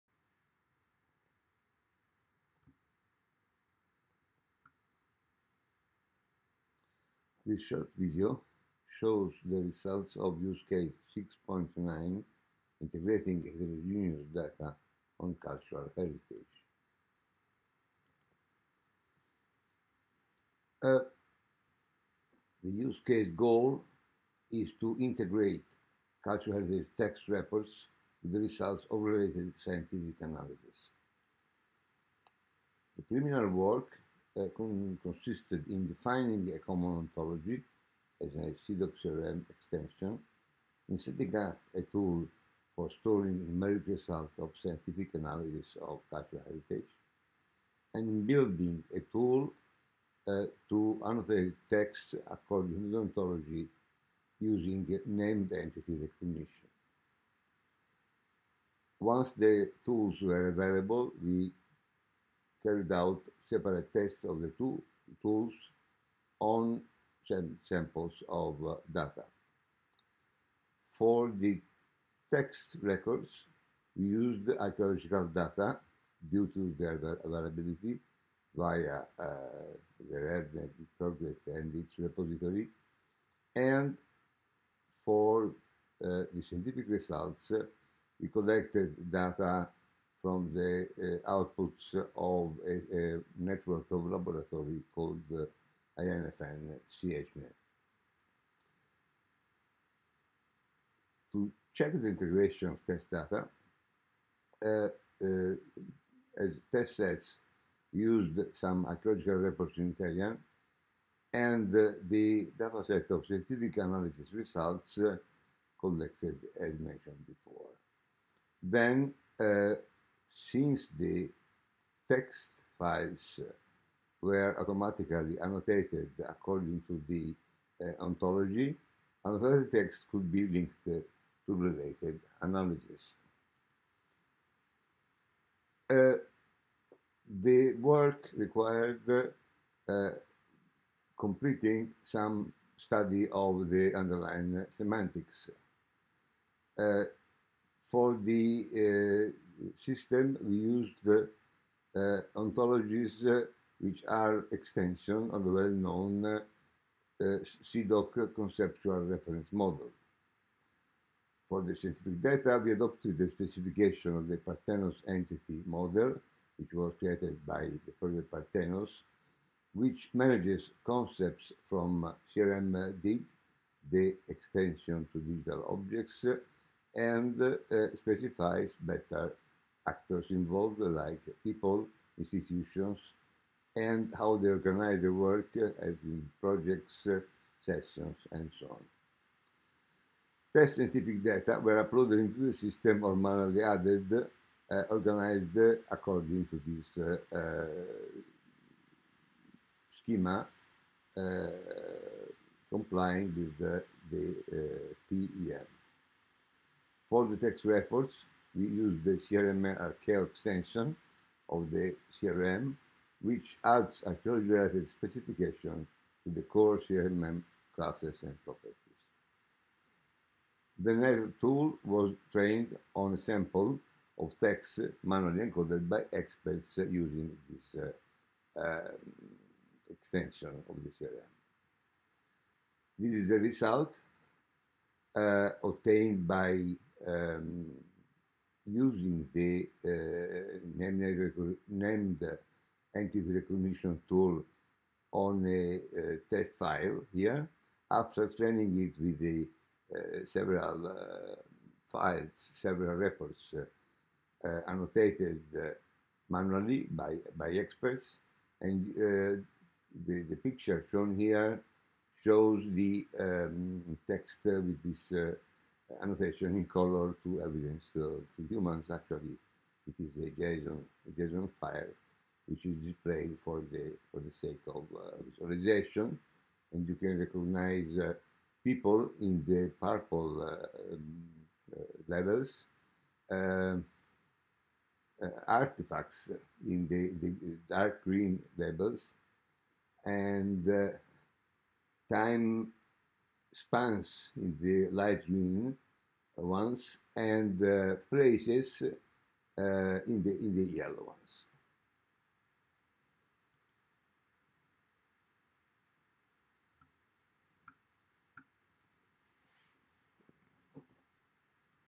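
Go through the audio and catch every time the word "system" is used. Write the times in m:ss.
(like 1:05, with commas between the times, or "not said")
2:29, 3:12.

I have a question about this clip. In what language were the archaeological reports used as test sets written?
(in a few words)
Italian.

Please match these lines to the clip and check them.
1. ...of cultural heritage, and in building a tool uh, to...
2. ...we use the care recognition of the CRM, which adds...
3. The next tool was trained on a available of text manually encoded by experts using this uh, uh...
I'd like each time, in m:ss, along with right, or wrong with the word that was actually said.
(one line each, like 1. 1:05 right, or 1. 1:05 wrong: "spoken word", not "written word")
1. 0:45 right
2. 3:28 wrong: "extension", not "recognition"
3. 3:40 wrong: "sample", not "available".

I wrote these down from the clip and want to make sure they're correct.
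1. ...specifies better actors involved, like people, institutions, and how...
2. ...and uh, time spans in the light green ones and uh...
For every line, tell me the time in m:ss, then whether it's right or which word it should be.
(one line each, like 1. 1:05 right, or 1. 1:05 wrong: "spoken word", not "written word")
1. 2:58 right
2. 4:50 right.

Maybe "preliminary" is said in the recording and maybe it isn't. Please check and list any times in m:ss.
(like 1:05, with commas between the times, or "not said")
0:33.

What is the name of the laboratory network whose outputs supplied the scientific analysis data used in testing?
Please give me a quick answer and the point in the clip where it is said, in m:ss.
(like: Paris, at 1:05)
INFN CHNet, at 1:35.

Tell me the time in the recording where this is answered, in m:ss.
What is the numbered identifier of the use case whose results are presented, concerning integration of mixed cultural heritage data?
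0:11.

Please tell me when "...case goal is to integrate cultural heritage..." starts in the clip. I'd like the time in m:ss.
0:23.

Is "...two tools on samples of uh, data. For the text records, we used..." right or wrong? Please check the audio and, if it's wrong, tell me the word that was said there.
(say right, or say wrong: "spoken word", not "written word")
right.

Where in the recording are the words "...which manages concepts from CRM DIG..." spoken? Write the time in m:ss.
2:49.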